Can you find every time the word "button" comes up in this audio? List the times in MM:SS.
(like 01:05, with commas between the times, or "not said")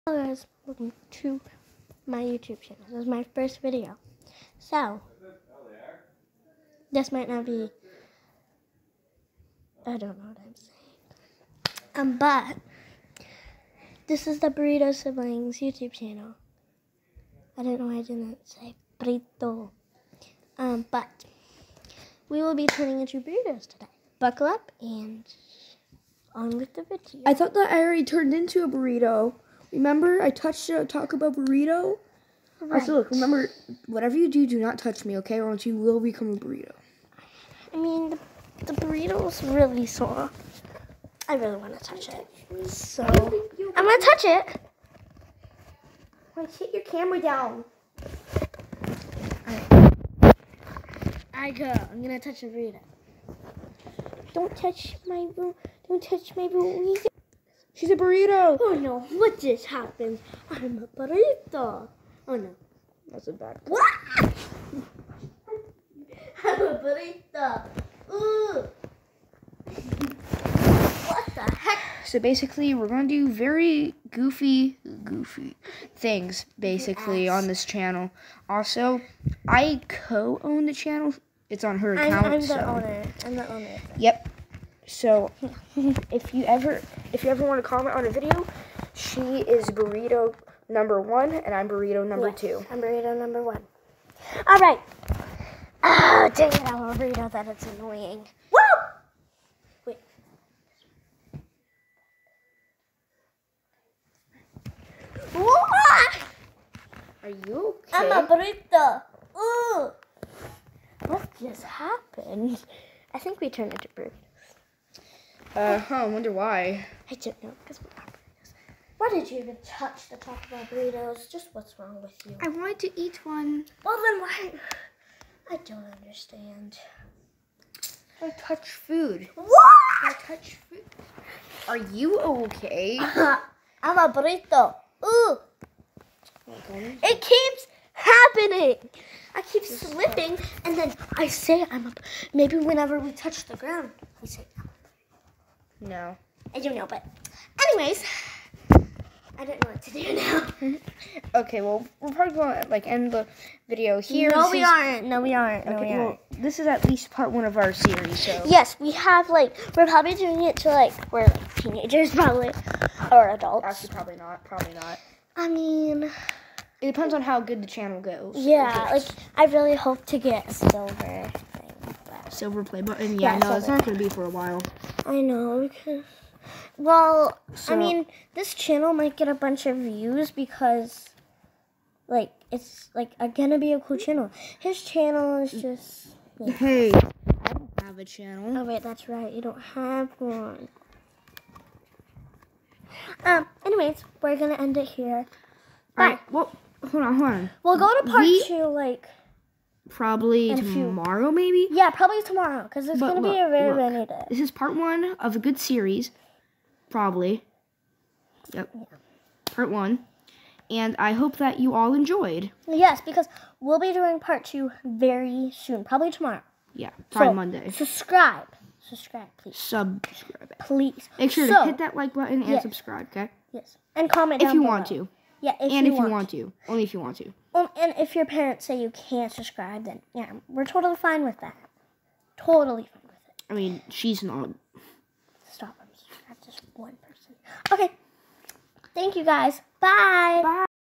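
02:52, 03:42.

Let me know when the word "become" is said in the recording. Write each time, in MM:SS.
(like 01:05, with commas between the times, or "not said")
00:35.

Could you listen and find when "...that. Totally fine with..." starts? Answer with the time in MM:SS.
03:51.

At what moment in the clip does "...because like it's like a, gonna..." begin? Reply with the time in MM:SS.
03:00.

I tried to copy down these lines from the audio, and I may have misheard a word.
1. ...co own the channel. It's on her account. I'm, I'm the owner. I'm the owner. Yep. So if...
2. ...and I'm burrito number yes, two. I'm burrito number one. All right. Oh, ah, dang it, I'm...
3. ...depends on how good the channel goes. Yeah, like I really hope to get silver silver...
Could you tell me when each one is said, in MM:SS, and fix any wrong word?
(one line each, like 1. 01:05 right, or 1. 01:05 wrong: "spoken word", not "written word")
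1. 01:19 right
2. 01:31 right
3. 02:46 right.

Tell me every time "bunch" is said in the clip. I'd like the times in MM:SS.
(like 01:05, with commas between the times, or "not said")
02:59.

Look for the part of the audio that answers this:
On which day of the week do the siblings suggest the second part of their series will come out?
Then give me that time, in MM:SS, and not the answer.
03:37.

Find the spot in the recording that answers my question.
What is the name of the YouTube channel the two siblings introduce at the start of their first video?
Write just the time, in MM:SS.
00:14.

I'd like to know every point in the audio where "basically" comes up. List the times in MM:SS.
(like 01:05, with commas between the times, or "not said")
01:12, 01:16.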